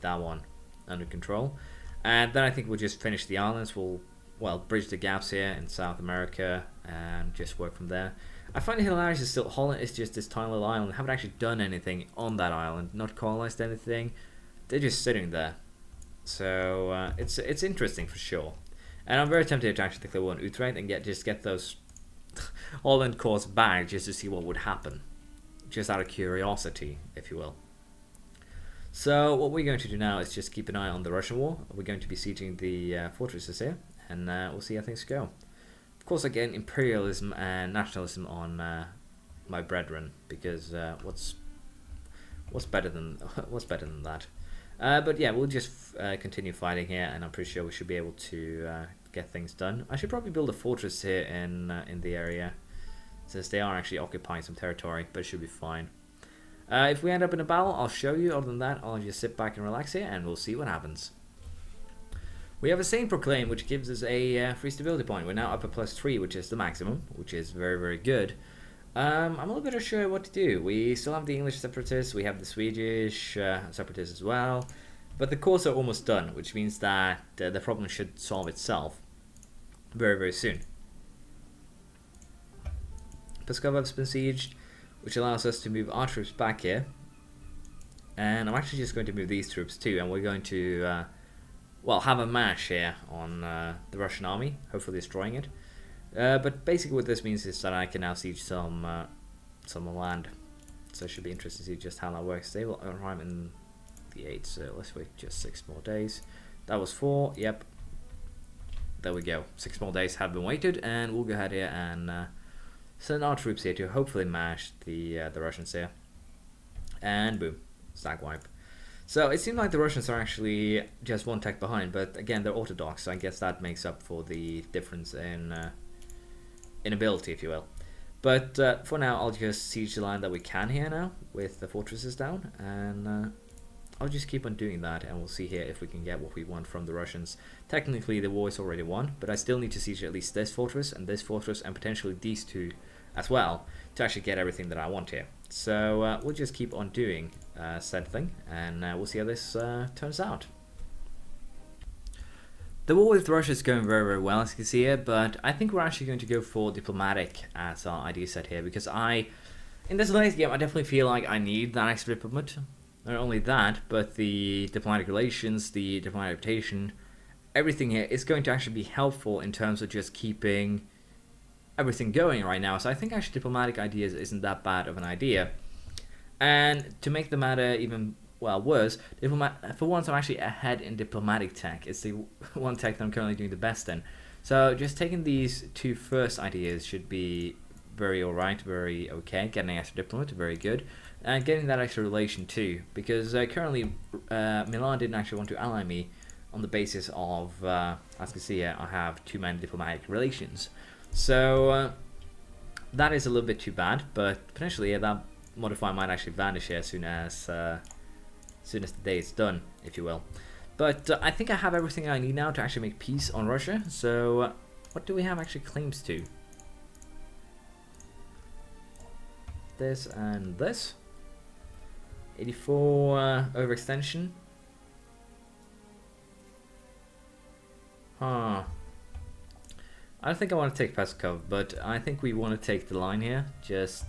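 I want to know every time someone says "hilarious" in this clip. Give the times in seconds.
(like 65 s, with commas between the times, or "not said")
8 s.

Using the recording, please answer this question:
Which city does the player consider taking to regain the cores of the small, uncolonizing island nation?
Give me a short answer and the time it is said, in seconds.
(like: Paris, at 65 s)
Utrecht, at 20 s.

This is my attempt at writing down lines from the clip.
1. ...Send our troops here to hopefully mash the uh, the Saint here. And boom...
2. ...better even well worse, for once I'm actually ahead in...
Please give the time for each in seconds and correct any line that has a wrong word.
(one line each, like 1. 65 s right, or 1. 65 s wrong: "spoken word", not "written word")
1. 113 s wrong: "Russians", not "Saint"
2. 177 s wrong: "matter", not "better".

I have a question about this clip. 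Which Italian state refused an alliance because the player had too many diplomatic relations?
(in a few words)
Milan.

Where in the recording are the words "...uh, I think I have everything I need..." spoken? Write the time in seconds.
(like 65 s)
211 s.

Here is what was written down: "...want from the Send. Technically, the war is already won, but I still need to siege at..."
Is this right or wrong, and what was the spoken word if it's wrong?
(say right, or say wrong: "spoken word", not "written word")
wrong: "Russians", not "Send".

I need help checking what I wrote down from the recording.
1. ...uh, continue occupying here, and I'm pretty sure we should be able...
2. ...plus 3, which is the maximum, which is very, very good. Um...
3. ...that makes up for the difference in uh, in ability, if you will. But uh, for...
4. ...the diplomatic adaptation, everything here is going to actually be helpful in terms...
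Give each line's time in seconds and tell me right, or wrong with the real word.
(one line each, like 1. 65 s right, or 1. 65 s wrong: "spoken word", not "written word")
1. 45 s wrong: "fighting", not "occupying"
2. 65 s right
3. 123 s right
4. 165 s right.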